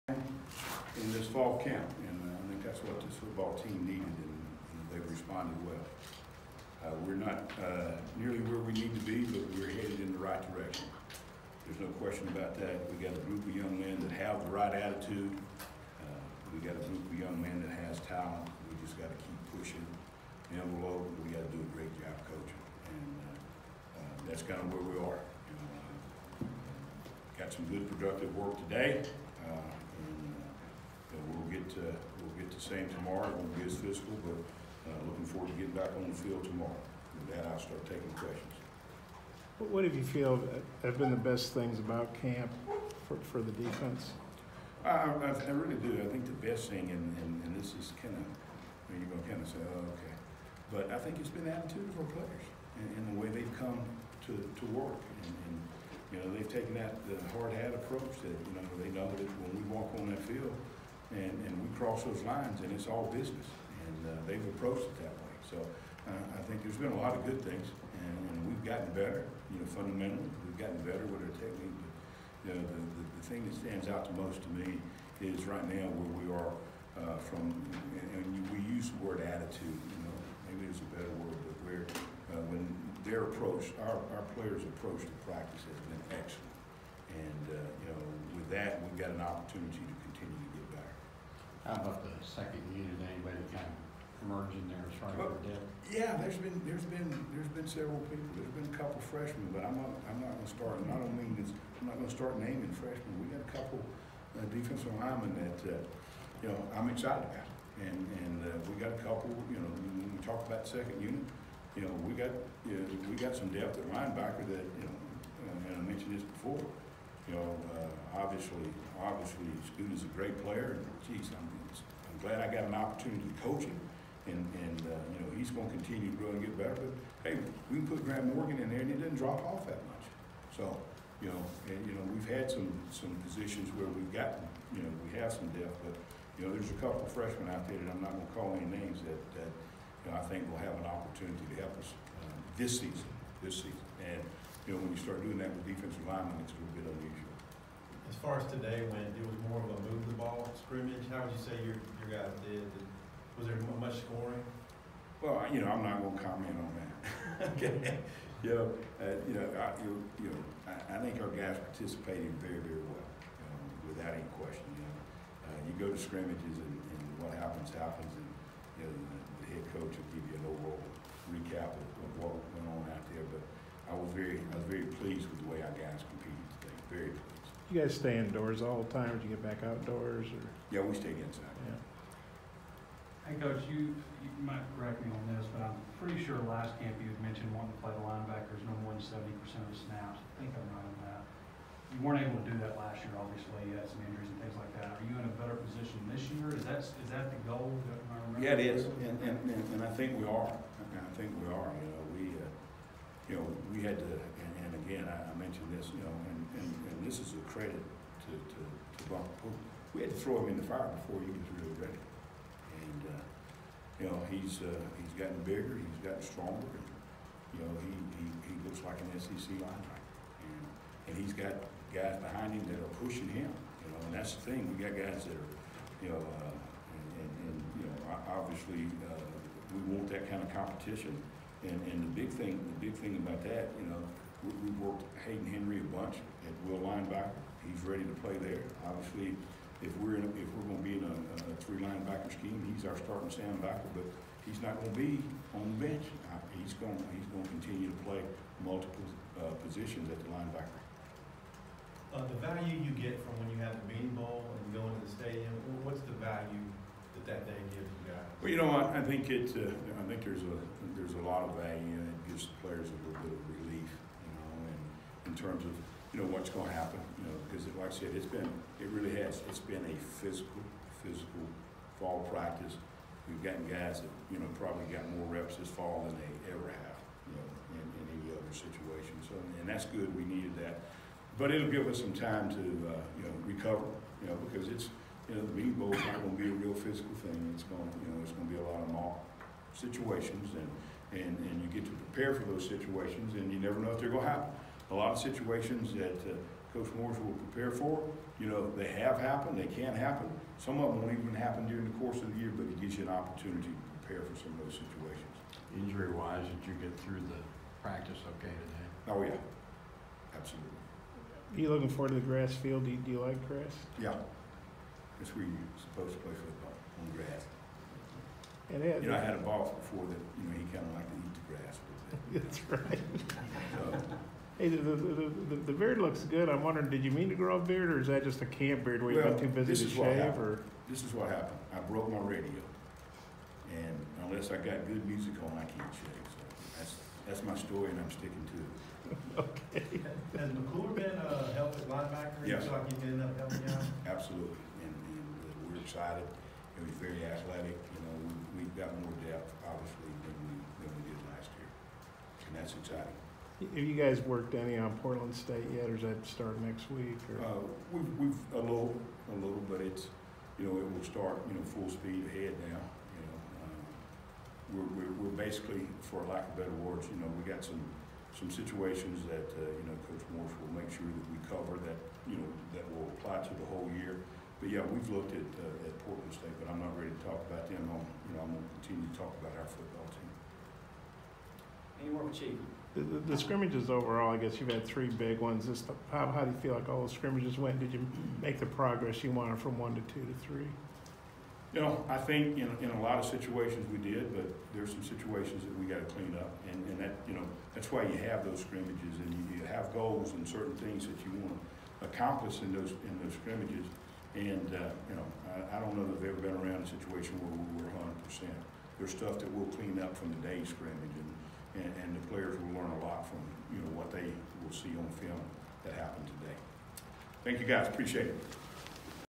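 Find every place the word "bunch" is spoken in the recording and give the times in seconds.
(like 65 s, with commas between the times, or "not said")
235 s.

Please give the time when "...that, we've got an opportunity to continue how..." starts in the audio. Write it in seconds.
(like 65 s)
88 s.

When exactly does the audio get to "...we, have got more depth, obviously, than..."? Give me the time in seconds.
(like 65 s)
348 s.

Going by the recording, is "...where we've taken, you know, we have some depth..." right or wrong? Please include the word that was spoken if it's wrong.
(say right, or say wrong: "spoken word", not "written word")
wrong: "gotten", not "taken".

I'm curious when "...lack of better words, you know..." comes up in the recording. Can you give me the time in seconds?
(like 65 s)
366 s.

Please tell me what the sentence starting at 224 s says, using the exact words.
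We got guys that are, you know, uh, and, and, and, you know, obviously uh, we want that kind of competition.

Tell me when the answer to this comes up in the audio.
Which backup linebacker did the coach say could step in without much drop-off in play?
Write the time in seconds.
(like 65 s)
128 s.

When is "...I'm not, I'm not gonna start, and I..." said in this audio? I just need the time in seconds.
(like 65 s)
99 s.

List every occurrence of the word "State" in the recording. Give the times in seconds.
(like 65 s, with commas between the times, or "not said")
355 s, 376 s.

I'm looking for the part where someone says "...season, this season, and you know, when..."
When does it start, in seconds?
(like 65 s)
142 s.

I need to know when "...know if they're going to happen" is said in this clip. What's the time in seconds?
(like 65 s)
293 s.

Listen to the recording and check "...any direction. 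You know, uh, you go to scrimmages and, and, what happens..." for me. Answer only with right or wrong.
wrong.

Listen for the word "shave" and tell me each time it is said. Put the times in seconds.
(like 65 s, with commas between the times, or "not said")
329 s, 335 s.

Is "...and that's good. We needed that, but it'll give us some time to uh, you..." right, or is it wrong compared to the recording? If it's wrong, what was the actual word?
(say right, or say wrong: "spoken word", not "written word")
right.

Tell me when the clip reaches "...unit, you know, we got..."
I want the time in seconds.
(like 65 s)
110 s.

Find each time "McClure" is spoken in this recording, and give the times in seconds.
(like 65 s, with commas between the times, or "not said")
340 s.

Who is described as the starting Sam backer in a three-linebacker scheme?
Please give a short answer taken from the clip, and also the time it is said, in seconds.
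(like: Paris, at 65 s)
Hayden Henry, at 235 s.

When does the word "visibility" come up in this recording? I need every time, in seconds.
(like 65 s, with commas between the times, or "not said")
not said.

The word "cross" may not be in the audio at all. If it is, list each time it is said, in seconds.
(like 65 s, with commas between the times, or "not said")
61 s.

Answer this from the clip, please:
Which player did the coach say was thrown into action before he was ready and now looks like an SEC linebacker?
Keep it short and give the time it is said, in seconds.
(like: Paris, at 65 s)
Bumper Pool, at 209 s.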